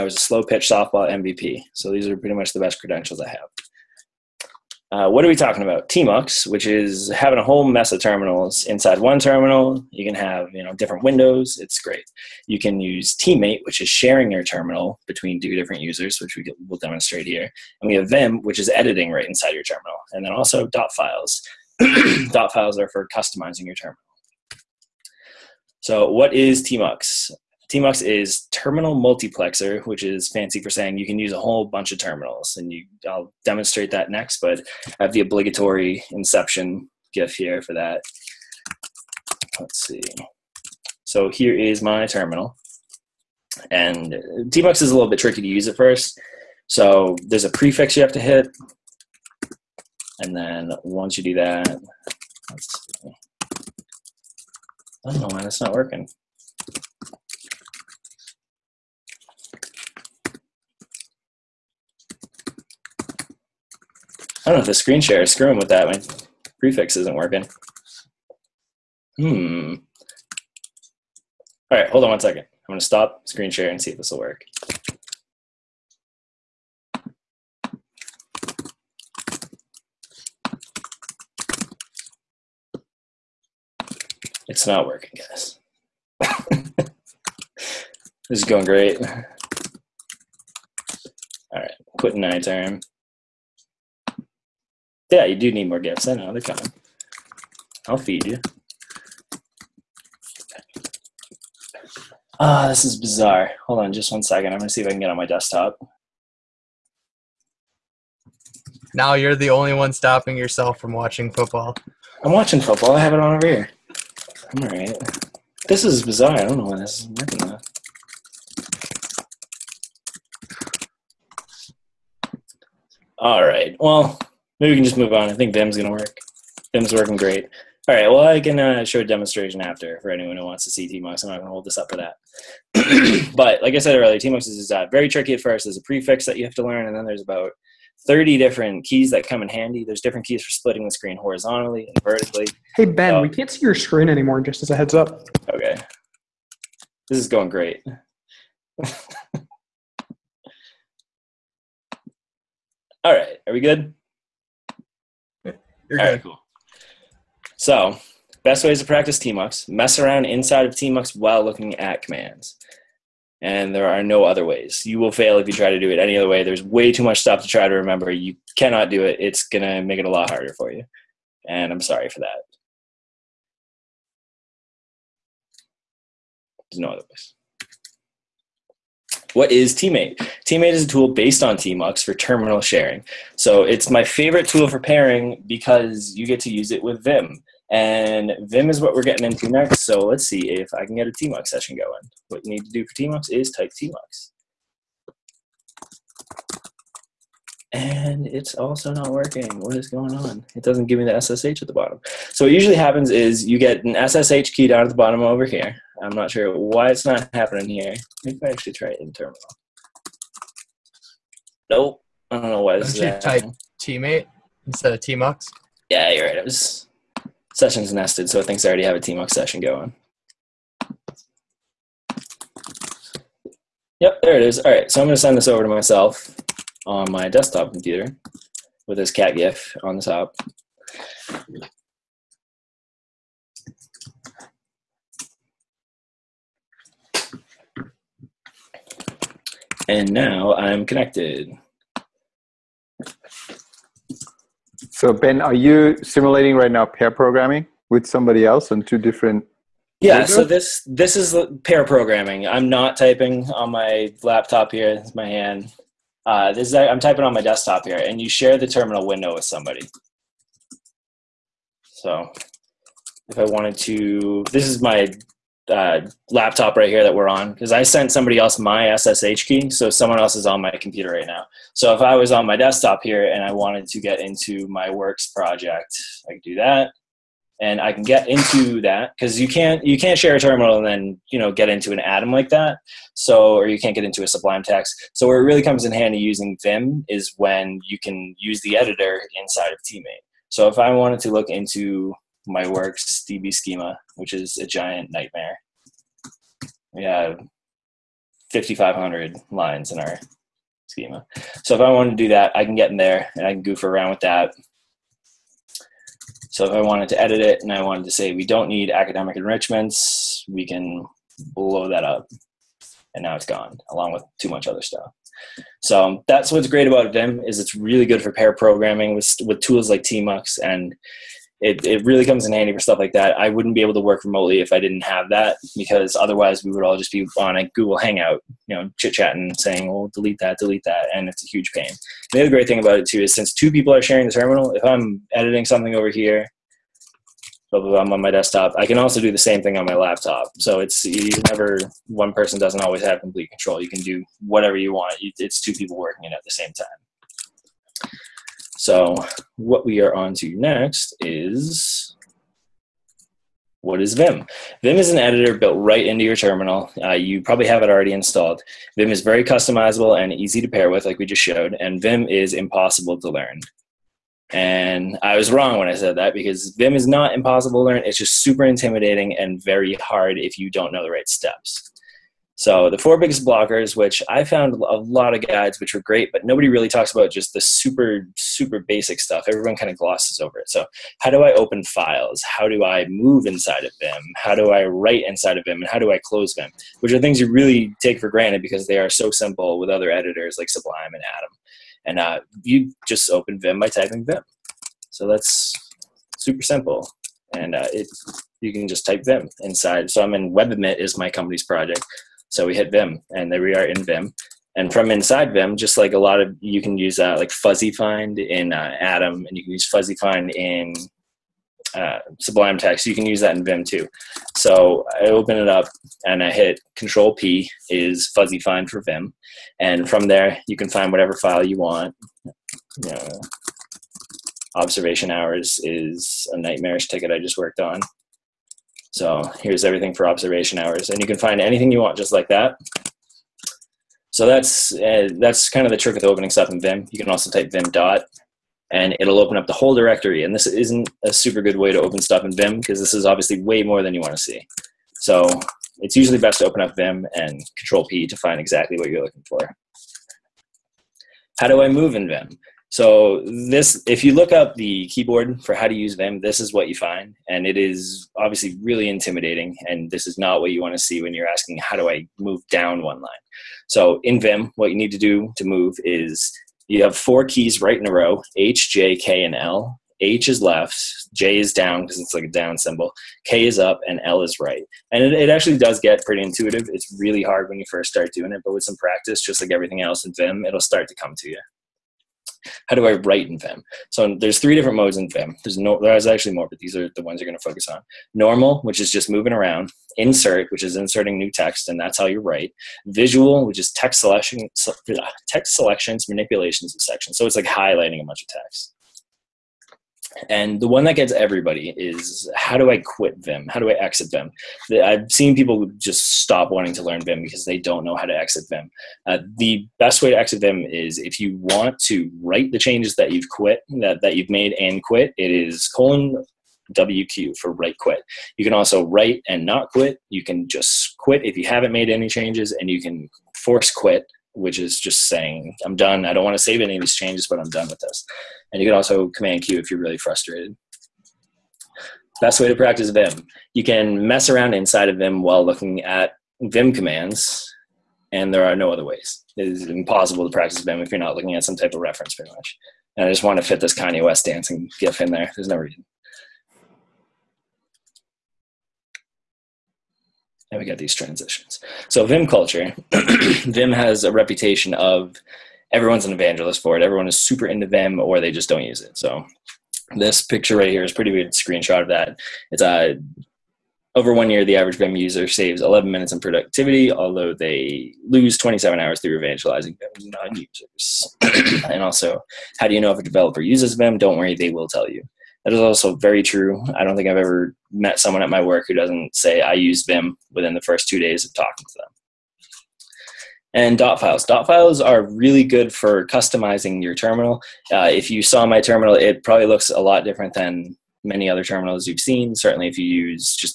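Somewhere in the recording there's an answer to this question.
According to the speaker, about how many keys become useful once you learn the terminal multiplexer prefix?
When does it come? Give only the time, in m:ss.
2:18.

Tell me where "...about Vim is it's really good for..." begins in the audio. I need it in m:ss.
5:16.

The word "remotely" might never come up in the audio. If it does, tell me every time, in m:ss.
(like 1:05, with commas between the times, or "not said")
5:24.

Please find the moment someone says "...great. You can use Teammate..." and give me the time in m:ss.
0:11.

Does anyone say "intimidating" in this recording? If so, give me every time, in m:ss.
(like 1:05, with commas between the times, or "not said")
6:08, 7:39.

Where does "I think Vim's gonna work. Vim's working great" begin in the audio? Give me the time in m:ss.
2:05.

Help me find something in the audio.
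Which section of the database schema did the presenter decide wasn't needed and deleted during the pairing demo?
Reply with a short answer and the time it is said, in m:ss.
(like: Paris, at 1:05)
Academic enrichments, at 5:08.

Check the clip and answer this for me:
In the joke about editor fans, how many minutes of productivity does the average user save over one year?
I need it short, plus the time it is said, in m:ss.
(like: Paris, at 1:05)
11, at 9:25.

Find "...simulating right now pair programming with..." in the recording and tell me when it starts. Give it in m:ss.
4:06.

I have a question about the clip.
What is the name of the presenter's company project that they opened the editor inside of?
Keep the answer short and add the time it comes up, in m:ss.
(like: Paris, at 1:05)
WebAdMIT, at 6:40.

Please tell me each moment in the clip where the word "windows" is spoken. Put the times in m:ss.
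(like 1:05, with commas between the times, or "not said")
0:11, 4:19.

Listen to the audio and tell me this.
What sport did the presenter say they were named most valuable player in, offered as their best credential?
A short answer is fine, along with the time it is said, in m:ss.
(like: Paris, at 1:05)
Slow pitch softball, at 0:00.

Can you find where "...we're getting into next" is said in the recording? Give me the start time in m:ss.
3:08.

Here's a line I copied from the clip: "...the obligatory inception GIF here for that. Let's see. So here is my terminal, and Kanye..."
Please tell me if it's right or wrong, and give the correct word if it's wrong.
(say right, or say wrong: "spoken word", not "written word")
wrong: "TMUX", not "Kanye".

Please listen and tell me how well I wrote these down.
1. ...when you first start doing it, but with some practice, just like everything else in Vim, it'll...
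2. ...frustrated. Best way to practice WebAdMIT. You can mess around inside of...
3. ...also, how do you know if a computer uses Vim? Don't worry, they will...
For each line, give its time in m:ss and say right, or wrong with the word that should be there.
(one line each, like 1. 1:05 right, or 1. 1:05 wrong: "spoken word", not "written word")
1. 7:57 right
2. 8:50 wrong: "Vim", not "WebAdMIT"
3. 9:32 wrong: "developer", not "computer".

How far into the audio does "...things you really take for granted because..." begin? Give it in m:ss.
6:27.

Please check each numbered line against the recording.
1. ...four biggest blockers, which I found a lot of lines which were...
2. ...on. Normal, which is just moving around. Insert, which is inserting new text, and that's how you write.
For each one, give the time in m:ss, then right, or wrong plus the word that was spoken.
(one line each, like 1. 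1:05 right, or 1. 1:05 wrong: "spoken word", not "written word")
1. 6:12 wrong: "guides", not "lines"
2. 8:07 right.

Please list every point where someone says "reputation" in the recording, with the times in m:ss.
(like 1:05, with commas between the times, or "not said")
9:14.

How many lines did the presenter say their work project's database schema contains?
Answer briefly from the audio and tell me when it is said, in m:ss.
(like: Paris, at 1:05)
5,500, at 4:58.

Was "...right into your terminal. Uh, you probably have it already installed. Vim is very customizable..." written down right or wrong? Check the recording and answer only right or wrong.
right.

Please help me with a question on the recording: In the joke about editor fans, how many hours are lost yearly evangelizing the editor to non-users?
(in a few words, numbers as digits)
27.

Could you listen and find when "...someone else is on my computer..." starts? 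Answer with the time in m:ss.
4:29.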